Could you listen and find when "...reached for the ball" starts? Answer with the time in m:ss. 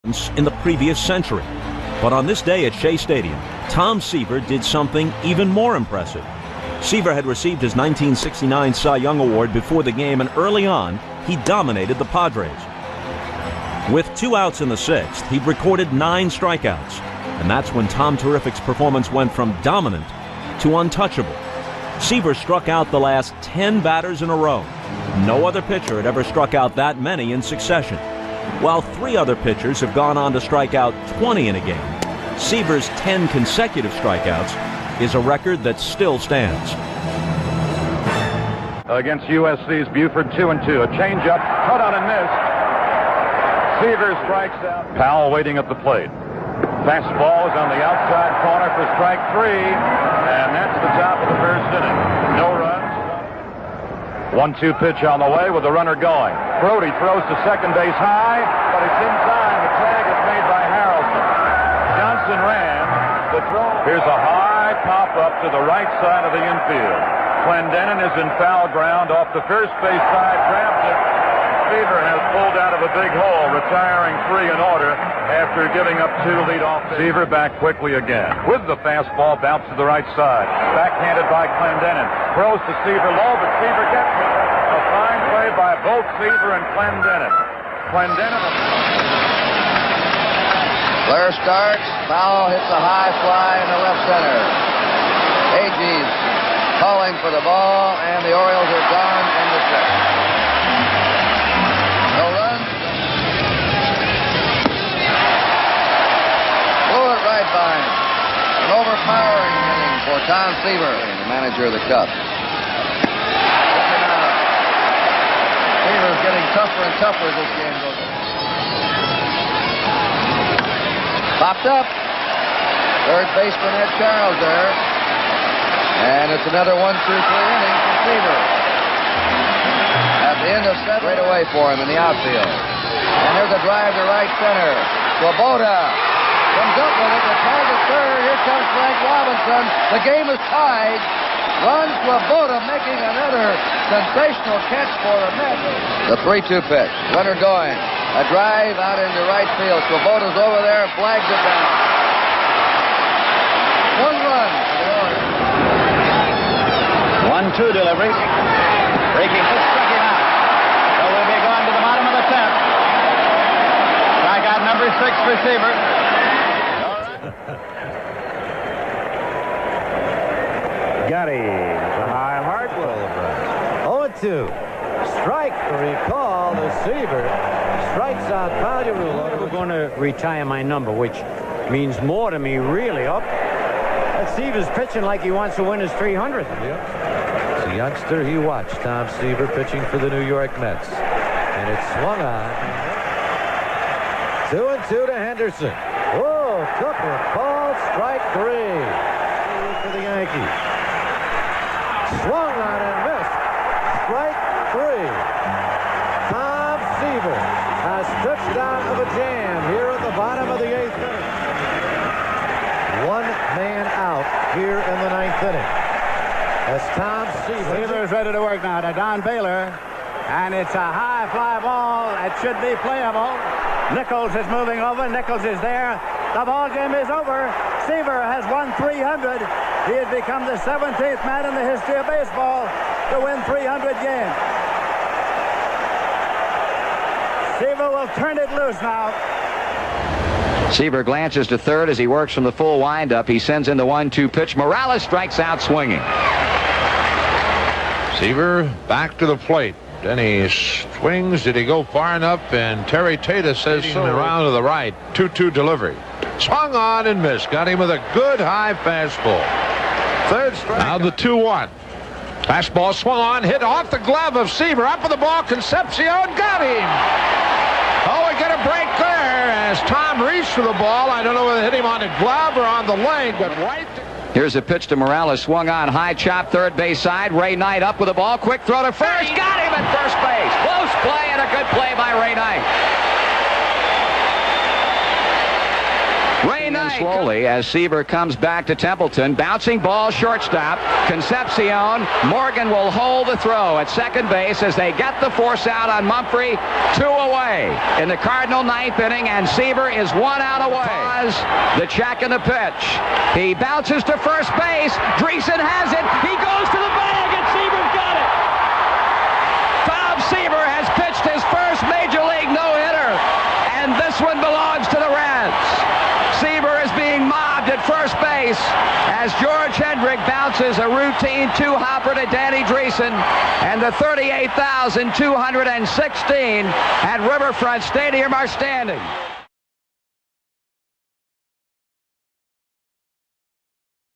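4:30.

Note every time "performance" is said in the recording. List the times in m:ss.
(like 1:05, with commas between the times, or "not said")
0:18.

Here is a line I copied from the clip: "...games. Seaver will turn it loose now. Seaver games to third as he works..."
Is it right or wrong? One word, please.
wrong.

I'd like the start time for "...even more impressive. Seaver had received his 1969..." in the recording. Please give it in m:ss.
0:05.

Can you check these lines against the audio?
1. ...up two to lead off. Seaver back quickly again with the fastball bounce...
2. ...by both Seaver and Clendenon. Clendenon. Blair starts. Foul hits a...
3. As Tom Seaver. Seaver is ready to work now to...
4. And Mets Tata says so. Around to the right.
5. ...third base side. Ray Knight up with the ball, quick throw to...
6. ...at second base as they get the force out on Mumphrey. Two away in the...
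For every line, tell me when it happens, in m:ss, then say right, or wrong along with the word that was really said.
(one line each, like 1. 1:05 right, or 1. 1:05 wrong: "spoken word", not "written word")
1. 1:16 right
2. 1:25 right
3. 3:36 right
4. 4:12 wrong: "Terry", not "Mets"
5. 4:36 right
6. 4:53 right.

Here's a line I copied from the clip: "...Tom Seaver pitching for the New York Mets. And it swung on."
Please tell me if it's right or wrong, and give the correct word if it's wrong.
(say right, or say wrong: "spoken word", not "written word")
right.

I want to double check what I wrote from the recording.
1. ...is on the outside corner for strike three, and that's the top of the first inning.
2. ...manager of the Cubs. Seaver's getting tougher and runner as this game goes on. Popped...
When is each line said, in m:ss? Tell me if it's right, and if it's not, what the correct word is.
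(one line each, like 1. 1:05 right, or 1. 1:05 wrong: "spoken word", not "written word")
1. 0:47 right
2. 1:51 wrong: "tougher", not "runner".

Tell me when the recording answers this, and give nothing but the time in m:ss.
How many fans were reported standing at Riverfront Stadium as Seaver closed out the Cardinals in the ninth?
5:23.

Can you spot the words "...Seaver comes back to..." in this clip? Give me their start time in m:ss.
4:47.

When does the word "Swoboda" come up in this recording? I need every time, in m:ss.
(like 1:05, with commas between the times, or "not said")
2:15, 2:22, 2:29.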